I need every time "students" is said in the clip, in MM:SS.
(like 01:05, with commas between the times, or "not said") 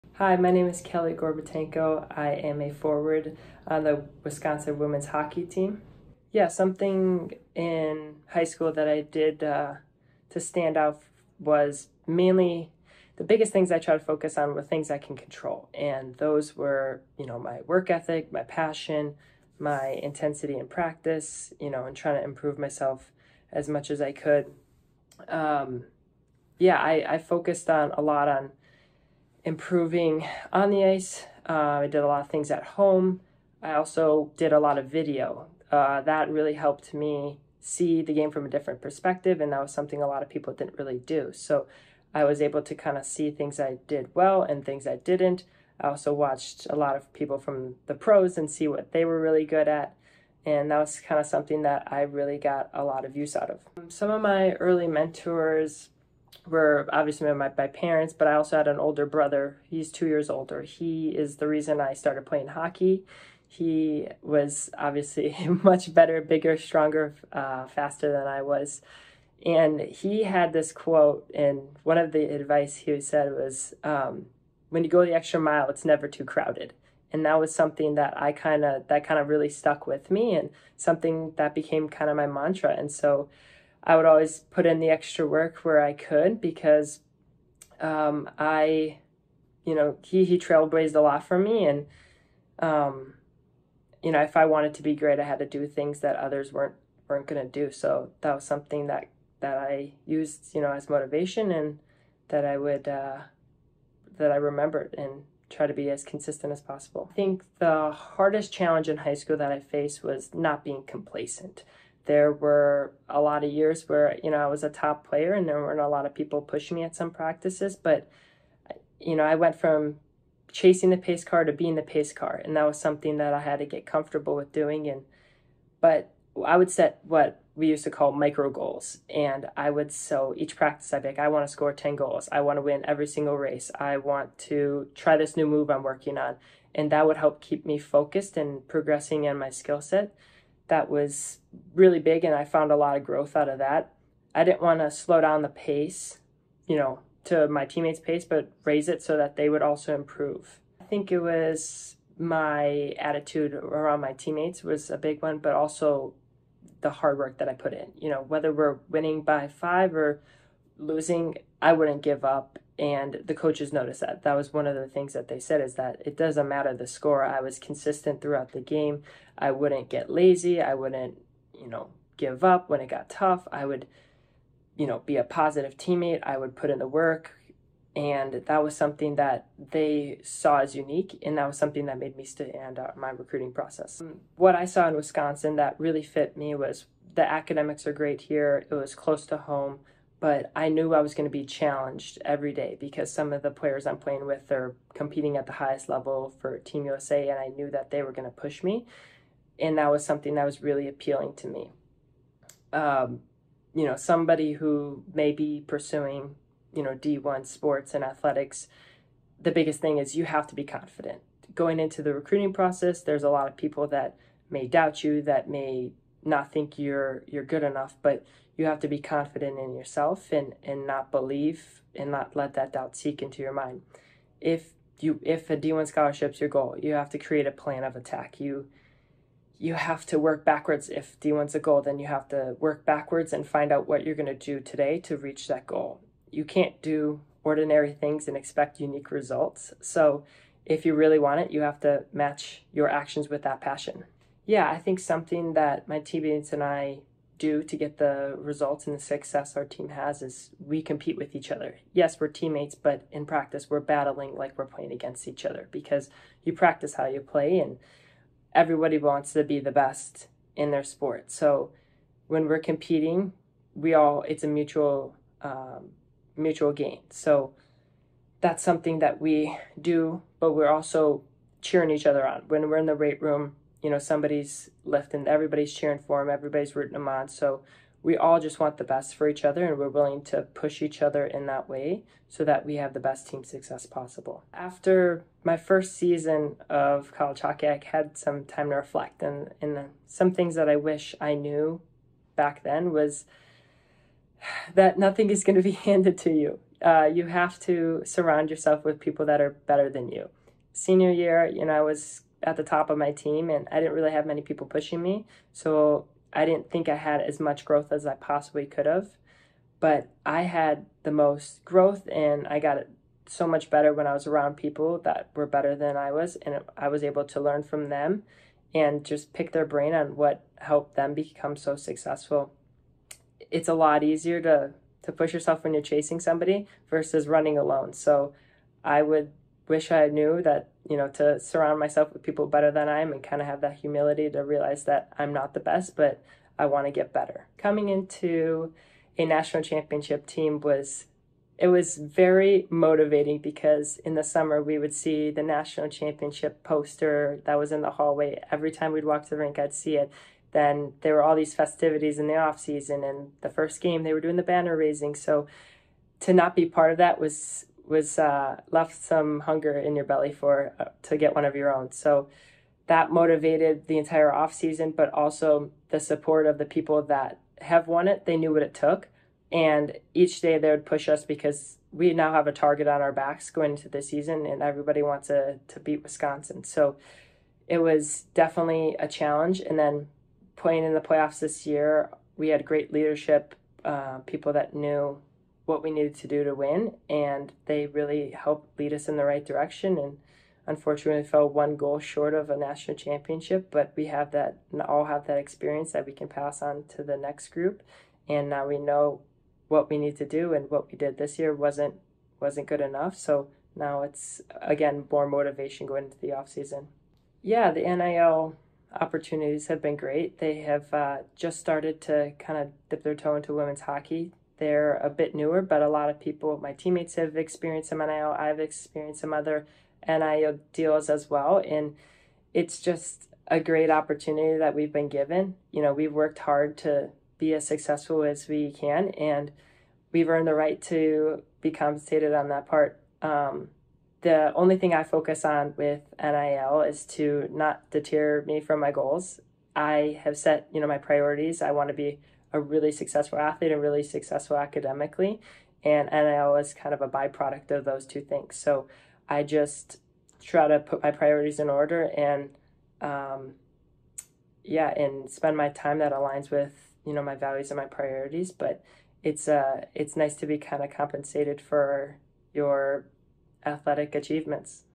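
not said.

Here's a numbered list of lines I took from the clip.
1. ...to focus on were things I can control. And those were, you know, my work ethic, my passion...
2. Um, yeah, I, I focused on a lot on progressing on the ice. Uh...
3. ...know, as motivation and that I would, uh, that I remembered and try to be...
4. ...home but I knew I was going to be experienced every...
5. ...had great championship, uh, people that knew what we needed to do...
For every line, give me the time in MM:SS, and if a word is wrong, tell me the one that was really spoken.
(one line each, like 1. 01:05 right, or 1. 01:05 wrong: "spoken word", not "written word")
1. 00:13 right
2. 00:25 wrong: "improving", not "progressing"
3. 01:40 right
4. 03:09 wrong: "challenged", not "experienced"
5. 06:22 wrong: "leadership", not "championship".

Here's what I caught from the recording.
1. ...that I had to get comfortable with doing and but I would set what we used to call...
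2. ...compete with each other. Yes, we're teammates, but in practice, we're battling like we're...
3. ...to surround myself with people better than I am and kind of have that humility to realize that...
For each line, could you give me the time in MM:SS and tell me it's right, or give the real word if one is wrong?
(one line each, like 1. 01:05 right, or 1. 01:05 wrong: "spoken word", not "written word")
1. 02:03 right
2. 04:10 right
3. 05:31 right.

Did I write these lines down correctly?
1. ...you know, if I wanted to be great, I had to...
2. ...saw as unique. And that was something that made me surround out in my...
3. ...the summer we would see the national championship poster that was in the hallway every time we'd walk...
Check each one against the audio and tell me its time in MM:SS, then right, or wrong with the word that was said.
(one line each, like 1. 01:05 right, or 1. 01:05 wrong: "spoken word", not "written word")
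1. 01:34 right
2. 03:00 wrong: "stand", not "surround"
3. 05:44 right.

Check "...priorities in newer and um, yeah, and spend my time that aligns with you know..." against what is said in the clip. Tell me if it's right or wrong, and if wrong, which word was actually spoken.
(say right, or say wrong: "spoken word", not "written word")
wrong: "order", not "newer".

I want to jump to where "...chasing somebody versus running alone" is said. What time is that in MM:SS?
05:25.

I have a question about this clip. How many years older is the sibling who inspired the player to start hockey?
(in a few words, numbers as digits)
2.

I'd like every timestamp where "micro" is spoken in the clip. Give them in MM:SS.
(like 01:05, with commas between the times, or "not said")
02:08.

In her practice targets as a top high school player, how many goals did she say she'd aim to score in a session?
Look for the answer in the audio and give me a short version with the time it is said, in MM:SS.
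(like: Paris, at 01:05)
10, at 02:11.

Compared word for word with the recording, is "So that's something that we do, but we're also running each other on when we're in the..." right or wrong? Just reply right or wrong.
wrong.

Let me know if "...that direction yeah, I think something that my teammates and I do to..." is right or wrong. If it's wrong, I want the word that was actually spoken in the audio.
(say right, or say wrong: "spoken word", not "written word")
wrong: "passion", not "direction".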